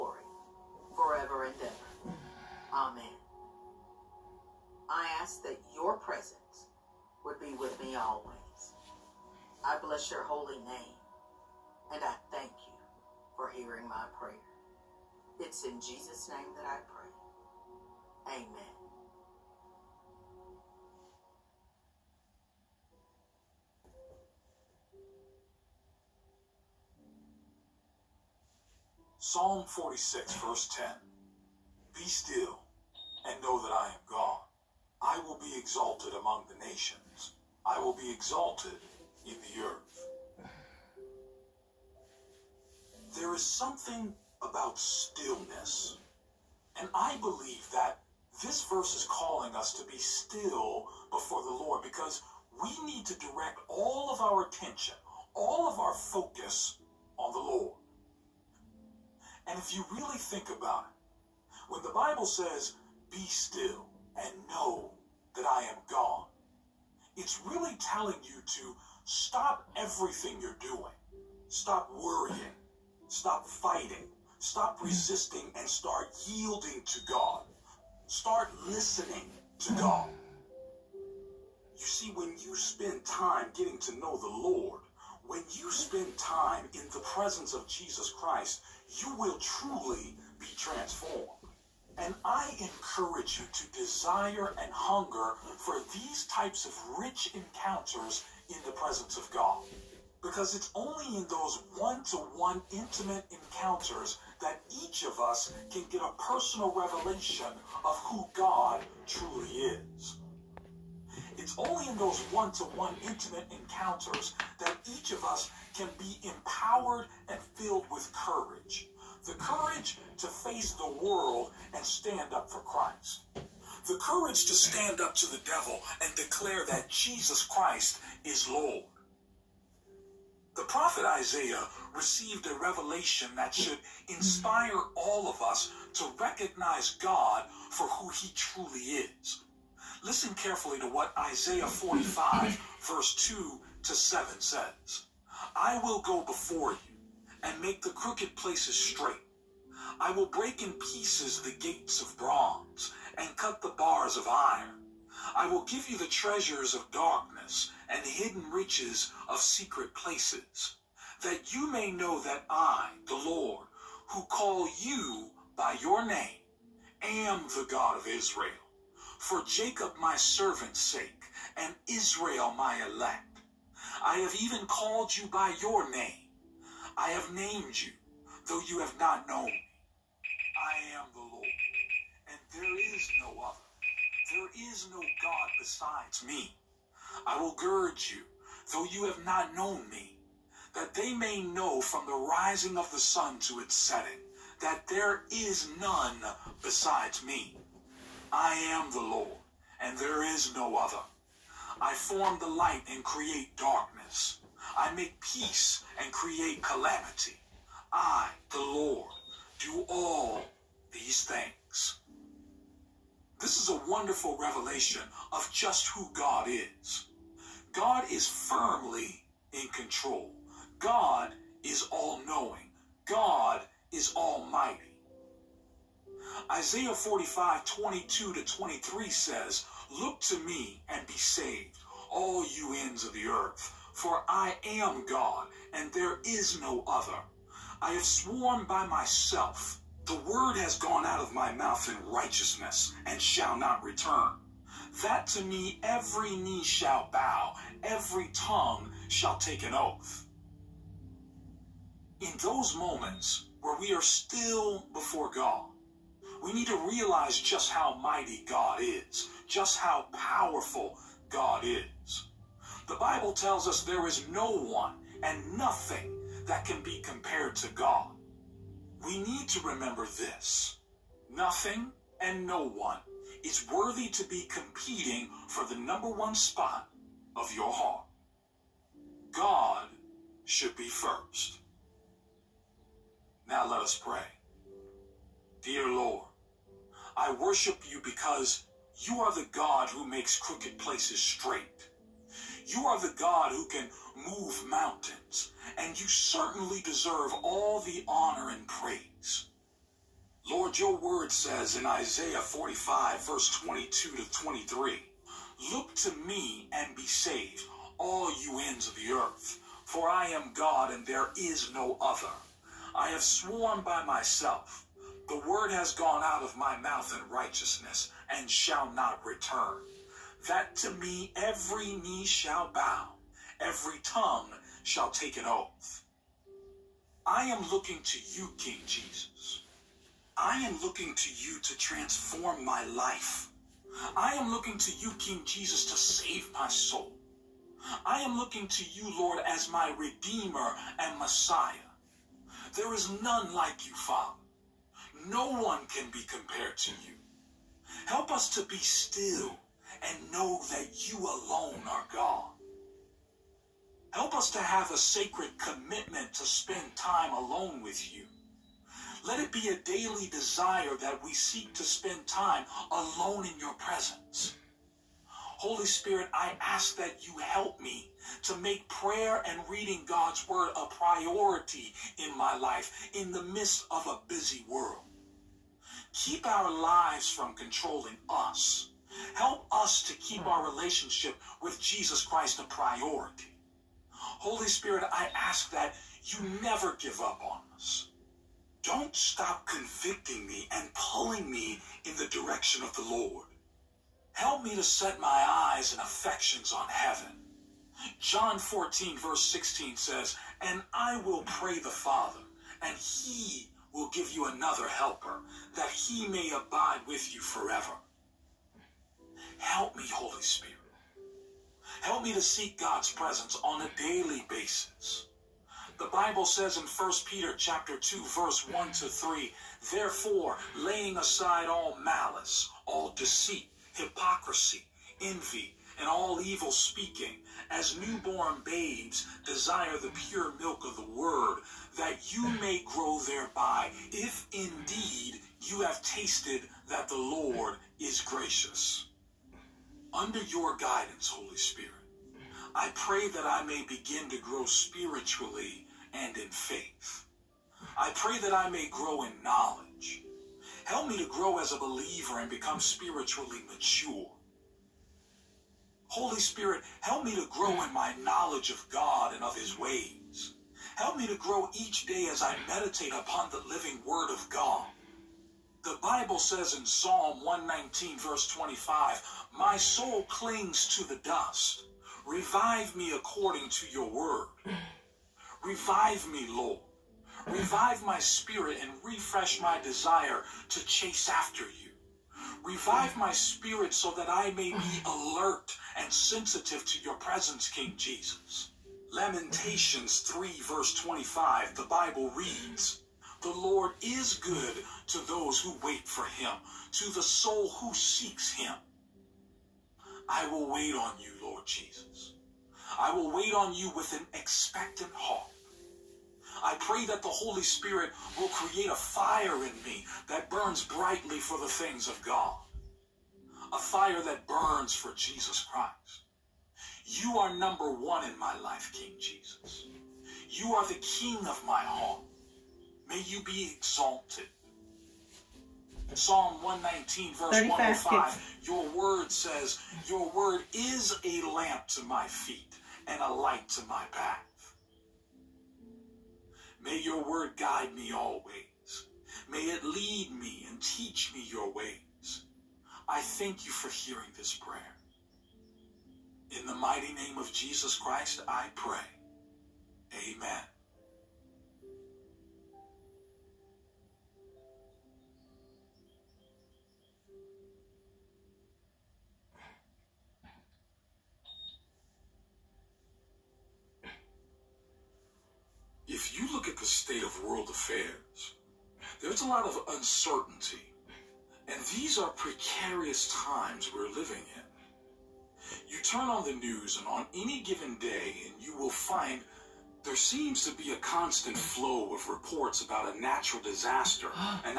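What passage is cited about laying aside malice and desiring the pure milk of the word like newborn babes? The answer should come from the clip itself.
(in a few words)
1 Peter 2:1-3.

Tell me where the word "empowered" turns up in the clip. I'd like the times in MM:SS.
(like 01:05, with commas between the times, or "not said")
01:56.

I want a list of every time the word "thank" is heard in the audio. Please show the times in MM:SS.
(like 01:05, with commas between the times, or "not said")
00:12, 09:03.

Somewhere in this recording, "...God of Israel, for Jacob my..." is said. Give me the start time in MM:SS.
02:47.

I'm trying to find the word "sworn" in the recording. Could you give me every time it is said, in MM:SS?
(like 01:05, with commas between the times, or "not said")
03:58, 05:13.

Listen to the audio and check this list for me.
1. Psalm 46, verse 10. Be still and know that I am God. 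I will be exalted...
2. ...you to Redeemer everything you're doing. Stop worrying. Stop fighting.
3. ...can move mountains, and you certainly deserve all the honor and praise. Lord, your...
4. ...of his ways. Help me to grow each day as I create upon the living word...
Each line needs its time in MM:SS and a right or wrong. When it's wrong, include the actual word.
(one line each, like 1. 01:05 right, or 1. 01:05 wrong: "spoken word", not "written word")
1. 00:29 right
2. 01:08 wrong: "Stop", not "Redeemer"
3. 04:53 right
4. 07:39 wrong: "meditate", not "create".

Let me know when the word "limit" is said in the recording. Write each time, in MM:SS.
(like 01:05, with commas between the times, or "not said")
not said.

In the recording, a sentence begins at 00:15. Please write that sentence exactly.
It's in Jesus' name that I pray.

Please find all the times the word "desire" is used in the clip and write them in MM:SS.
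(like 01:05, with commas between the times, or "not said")
01:33, 06:00, 07:09, 07:59.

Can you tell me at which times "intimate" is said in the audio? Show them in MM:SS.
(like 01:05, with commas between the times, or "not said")
01:42, 01:53.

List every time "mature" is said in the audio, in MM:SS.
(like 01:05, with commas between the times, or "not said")
07:33.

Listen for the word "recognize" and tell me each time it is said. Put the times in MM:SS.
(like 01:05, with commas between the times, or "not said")
02:16.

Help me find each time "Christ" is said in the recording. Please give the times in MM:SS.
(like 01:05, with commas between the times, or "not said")
01:28, 02:02, 02:07, 06:22, 08:35, 09:07.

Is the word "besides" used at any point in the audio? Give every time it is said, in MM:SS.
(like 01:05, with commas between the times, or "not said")
03:05, 03:16.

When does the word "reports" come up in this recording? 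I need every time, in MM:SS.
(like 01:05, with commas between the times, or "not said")
09:42.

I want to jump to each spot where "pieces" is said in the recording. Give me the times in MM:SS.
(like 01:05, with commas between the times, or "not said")
02:30.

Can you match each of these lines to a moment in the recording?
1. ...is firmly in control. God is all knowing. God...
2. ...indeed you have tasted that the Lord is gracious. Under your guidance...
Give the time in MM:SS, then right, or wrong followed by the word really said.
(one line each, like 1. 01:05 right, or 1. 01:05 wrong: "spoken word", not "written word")
1. 03:38 right
2. 07:14 right.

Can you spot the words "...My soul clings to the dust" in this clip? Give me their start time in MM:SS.
07:49.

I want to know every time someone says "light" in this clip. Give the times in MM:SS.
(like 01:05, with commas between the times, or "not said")
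03:22, 08:53.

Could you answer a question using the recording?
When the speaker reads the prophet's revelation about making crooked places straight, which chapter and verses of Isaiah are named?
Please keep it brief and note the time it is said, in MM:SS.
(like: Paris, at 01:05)
Isaiah 45:2-7, at 02:21.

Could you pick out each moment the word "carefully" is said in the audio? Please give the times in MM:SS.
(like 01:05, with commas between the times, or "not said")
02:20.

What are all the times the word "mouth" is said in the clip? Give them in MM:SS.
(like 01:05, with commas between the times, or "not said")
04:01, 05:16.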